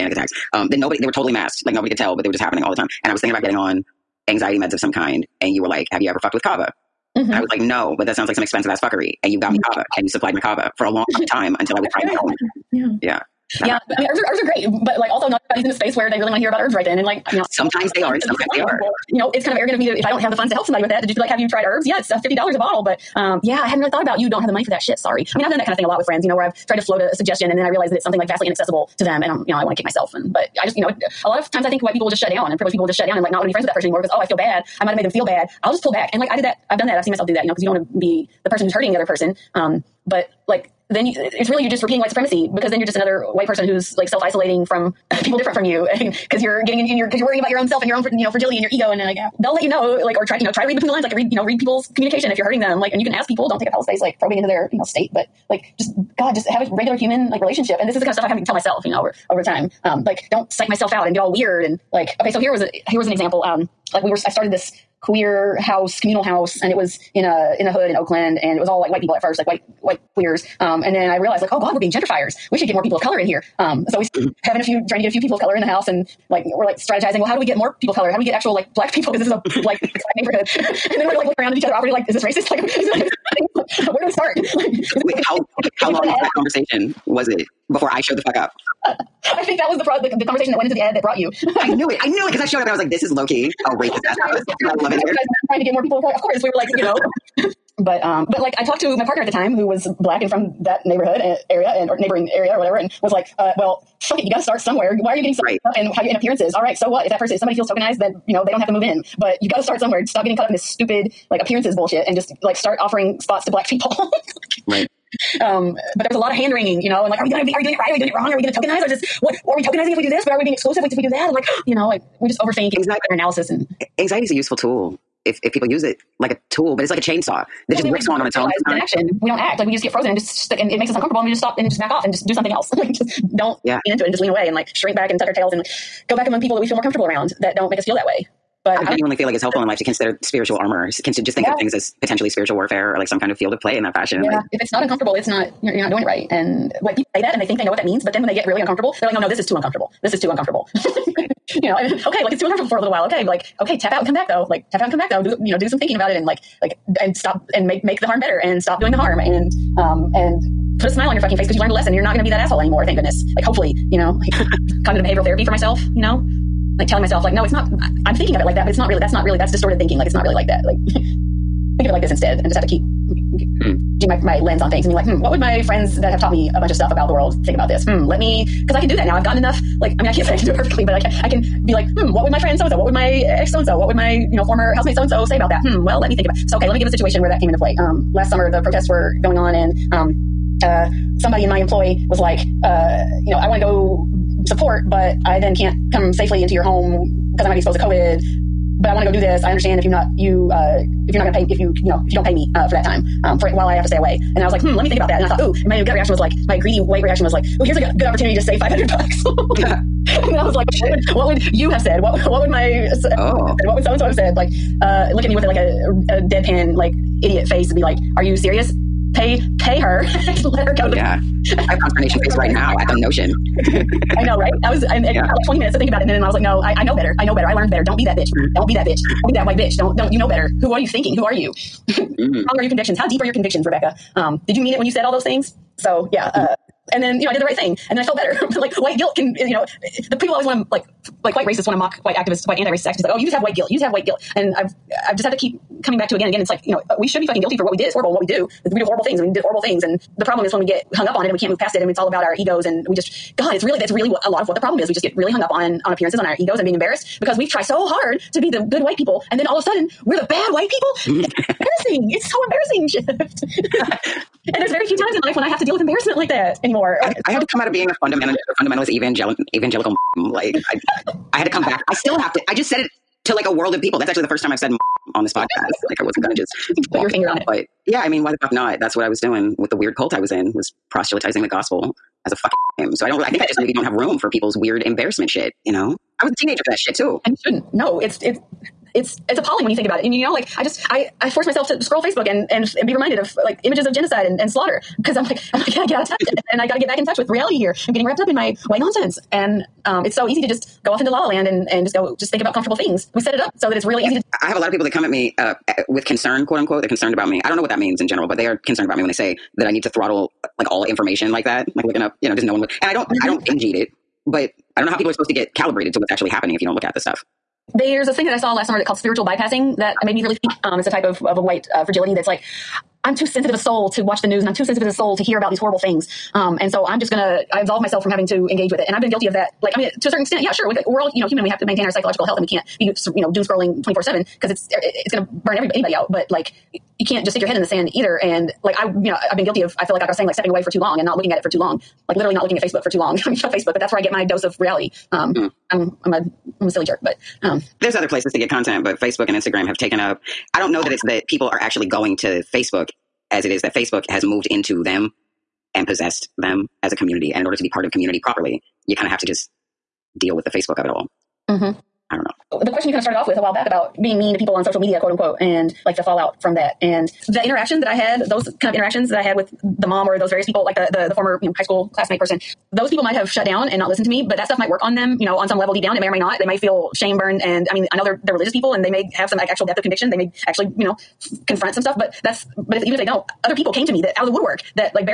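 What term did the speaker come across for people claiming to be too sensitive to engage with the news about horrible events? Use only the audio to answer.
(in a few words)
spiritual bypassing.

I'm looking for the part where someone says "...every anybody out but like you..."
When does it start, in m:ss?
5:35.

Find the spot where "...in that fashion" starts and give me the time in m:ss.
2:23.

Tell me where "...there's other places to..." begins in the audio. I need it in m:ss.
5:47.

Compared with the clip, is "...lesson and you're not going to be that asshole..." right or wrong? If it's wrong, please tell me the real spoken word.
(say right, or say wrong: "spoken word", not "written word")
right.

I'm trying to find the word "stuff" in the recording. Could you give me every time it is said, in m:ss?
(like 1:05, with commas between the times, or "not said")
0:58, 2:56, 5:16, 6:14, 6:21.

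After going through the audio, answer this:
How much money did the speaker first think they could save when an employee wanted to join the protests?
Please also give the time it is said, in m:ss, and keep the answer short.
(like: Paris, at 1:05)
500, at 3:28.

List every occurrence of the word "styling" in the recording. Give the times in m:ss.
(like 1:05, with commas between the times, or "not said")
not said.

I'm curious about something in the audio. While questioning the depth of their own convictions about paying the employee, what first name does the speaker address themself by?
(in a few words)
Rebecca.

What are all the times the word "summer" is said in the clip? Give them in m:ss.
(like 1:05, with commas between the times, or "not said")
3:08, 5:18.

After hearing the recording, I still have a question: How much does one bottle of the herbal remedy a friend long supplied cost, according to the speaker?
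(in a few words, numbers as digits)
$50.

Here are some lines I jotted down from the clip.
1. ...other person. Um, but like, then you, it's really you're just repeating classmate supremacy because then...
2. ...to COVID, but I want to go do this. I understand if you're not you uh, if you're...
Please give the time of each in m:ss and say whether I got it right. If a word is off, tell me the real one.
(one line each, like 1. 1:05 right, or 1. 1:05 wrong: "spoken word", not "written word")
1. 0:38 wrong: "white", not "classmate"
2. 3:17 right.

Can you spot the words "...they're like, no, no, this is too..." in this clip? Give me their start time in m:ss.
2:29.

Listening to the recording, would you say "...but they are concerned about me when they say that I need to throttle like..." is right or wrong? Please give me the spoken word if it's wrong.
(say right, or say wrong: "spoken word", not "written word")
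right.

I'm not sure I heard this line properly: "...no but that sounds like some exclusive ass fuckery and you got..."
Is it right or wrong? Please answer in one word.
wrong.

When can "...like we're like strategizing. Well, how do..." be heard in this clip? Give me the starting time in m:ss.
1:16.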